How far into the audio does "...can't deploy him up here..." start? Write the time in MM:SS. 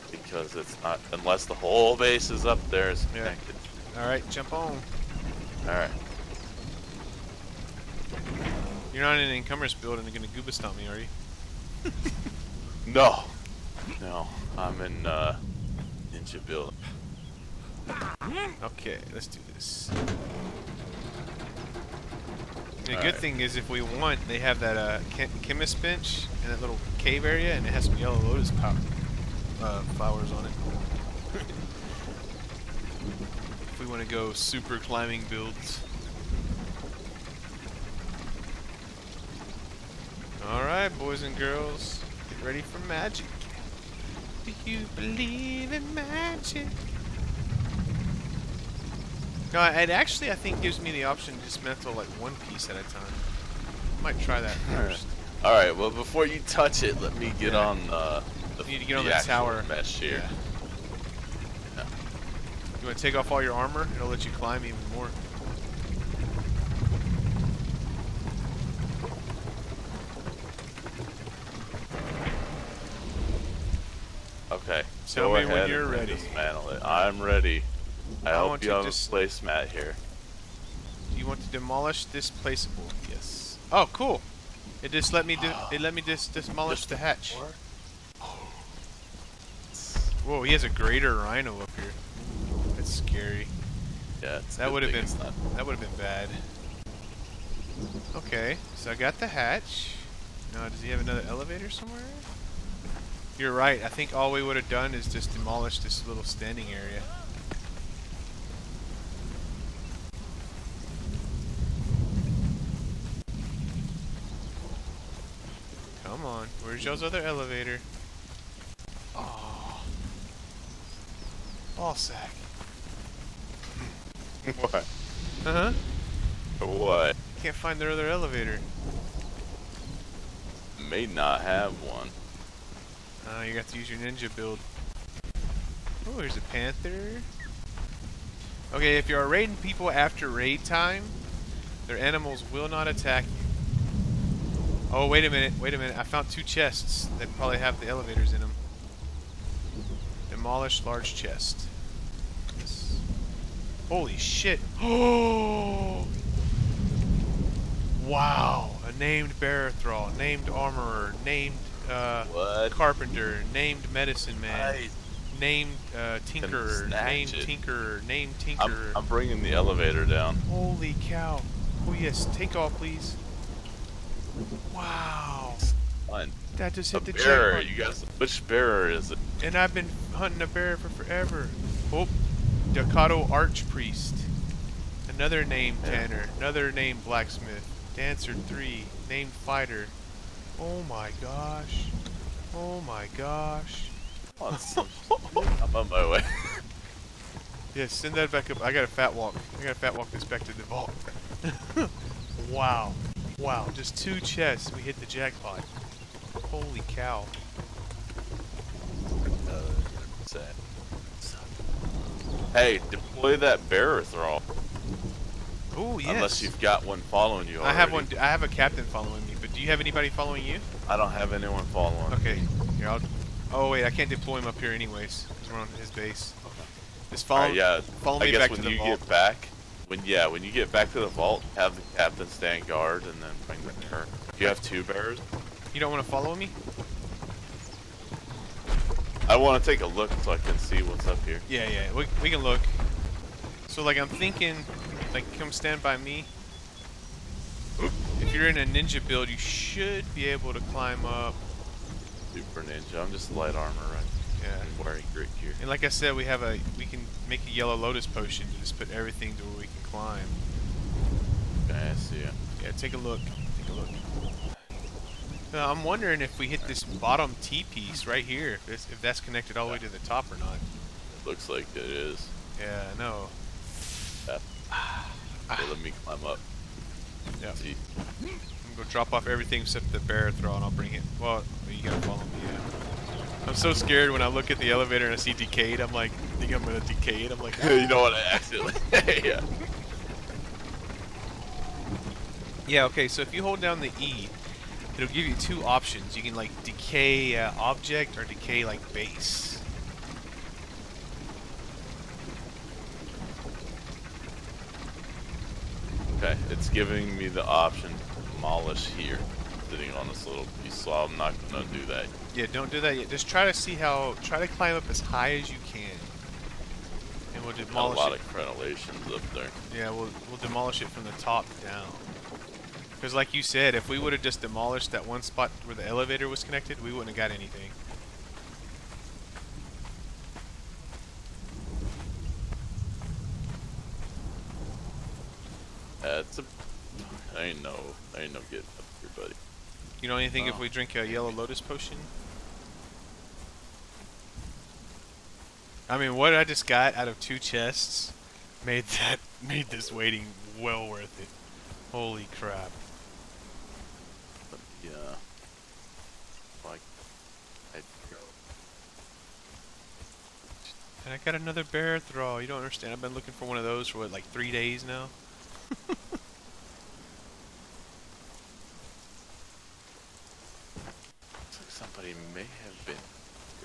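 03:43.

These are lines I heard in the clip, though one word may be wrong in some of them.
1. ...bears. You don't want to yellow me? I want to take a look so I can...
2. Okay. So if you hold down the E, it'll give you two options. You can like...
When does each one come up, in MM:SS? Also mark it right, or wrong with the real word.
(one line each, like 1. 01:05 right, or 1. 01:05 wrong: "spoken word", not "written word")
1. 03:54 wrong: "follow", not "yellow"
2. 04:52 right.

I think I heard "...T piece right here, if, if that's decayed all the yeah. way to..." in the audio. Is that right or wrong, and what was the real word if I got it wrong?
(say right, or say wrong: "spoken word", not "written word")
wrong: "connected", not "decayed".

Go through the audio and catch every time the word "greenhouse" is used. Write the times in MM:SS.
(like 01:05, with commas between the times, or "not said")
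not said.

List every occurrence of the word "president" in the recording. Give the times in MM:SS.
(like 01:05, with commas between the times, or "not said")
not said.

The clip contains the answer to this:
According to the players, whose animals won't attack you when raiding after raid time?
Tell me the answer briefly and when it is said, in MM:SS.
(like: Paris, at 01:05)
Their animals, at 02:21.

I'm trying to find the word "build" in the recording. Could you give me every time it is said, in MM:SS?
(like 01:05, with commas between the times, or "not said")
00:09, 00:16, 00:35, 02:14, 04:09.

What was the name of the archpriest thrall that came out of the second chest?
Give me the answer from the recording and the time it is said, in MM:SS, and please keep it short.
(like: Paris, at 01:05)
Dakado Archpriest, at 03:02.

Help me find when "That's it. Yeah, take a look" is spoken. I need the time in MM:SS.
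04:21.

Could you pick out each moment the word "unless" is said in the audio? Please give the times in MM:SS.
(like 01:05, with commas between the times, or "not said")
00:01, 03:36.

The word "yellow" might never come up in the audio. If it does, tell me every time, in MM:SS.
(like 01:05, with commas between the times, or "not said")
00:27, 04:17, 05:41.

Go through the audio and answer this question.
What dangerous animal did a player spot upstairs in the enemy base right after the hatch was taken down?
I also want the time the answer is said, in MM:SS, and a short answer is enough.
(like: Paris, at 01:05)
Greater rhino, at 01:30.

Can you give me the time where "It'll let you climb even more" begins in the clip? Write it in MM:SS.
01:03.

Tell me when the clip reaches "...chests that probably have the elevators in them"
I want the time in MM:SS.
02:26.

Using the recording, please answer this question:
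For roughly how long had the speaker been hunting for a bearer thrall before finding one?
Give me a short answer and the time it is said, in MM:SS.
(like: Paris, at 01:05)
3 days, at 06:04.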